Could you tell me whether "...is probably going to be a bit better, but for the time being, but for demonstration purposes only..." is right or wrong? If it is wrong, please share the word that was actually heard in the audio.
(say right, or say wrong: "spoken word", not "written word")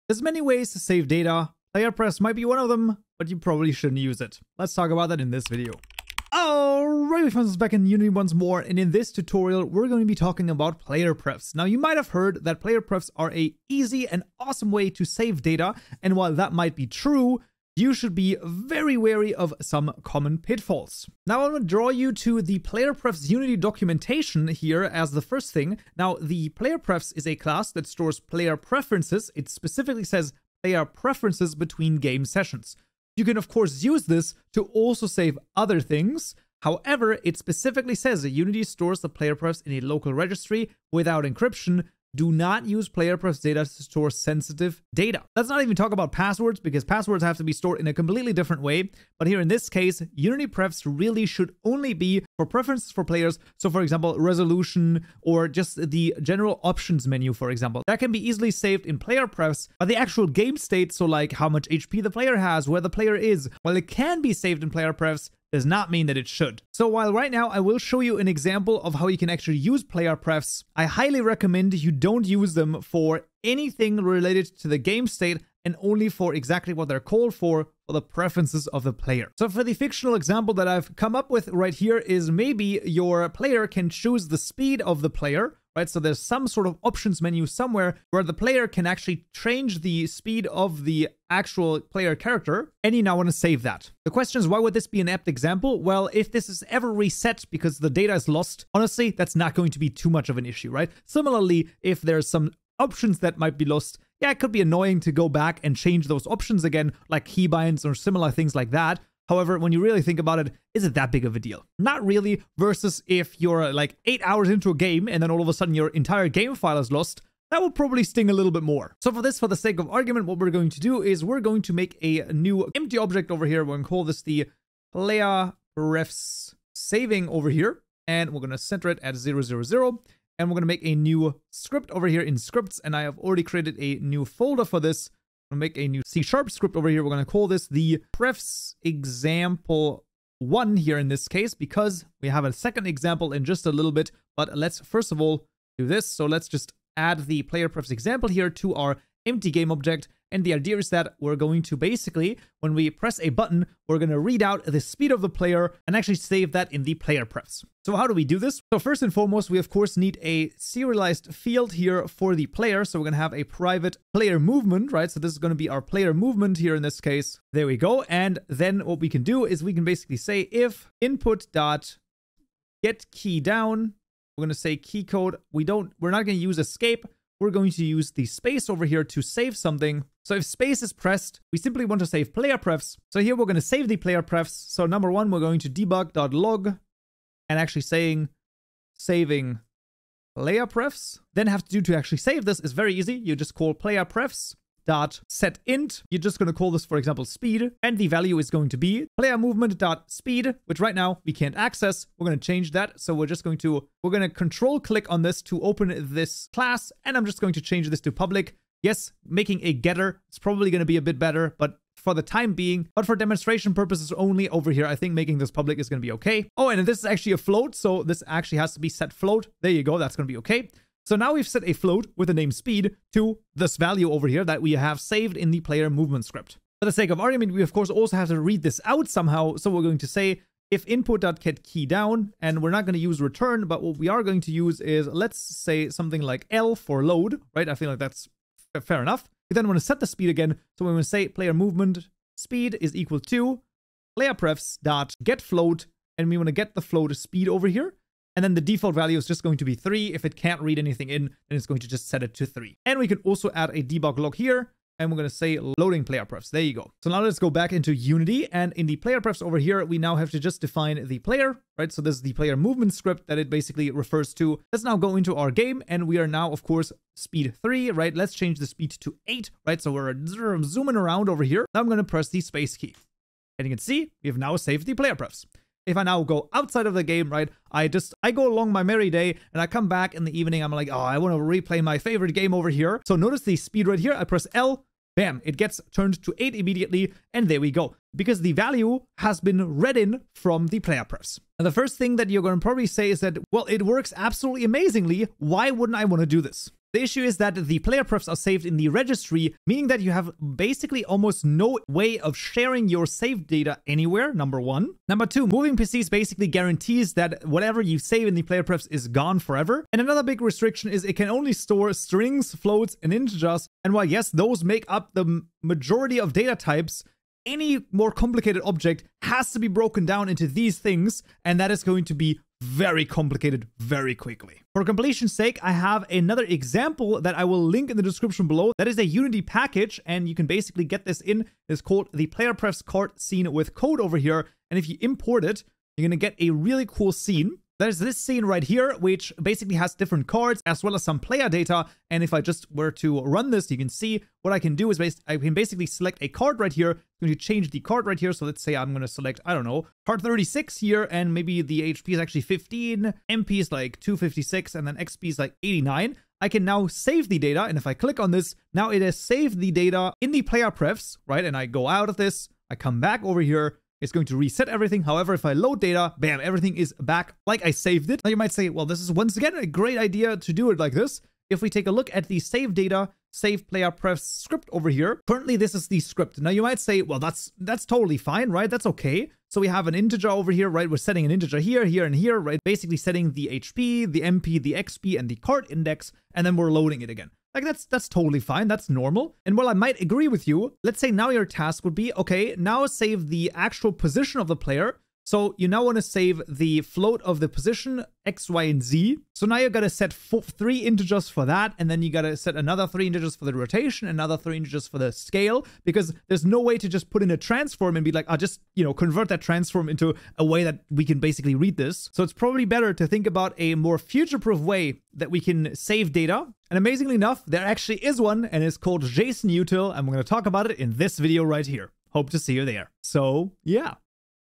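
right.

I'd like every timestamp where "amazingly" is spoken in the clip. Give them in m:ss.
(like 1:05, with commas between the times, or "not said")
4:54, 6:56.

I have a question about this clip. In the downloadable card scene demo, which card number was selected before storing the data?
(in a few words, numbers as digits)
36.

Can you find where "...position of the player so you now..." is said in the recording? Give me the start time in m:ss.
6:33.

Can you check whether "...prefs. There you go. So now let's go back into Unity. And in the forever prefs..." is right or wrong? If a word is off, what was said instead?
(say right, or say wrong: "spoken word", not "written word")
wrong: "player", not "forever".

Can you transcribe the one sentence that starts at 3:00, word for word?
So if space is pressed, we simply want to save player prefs.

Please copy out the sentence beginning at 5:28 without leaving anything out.
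That is a Unity package, and you can basically get this in.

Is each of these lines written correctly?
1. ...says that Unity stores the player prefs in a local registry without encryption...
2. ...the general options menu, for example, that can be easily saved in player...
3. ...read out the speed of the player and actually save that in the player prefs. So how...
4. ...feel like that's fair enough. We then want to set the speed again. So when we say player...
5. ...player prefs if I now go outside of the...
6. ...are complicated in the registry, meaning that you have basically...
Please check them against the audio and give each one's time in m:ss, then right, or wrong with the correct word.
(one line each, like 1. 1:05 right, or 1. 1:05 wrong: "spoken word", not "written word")
1. 0:37 right
2. 0:55 right
3. 2:34 right
4. 3:57 right
5. 4:34 right
6. 4:58 wrong: "saved", not "complicated".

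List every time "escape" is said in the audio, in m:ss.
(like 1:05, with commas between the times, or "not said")
2:56.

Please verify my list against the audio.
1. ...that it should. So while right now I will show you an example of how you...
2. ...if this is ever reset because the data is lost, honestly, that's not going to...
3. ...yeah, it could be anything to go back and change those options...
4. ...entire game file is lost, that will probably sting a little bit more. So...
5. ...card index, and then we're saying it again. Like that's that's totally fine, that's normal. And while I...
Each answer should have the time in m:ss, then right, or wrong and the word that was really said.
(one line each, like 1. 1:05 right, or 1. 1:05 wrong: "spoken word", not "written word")
1. 1:06 right
2. 1:36 right
3. 1:44 wrong: "annoying", not "anything"
4. 1:55 right
5. 6:25 wrong: "loading", not "saying".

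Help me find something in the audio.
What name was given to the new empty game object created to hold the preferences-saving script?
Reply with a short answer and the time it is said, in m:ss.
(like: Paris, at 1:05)
player prefs saving, at 2:04.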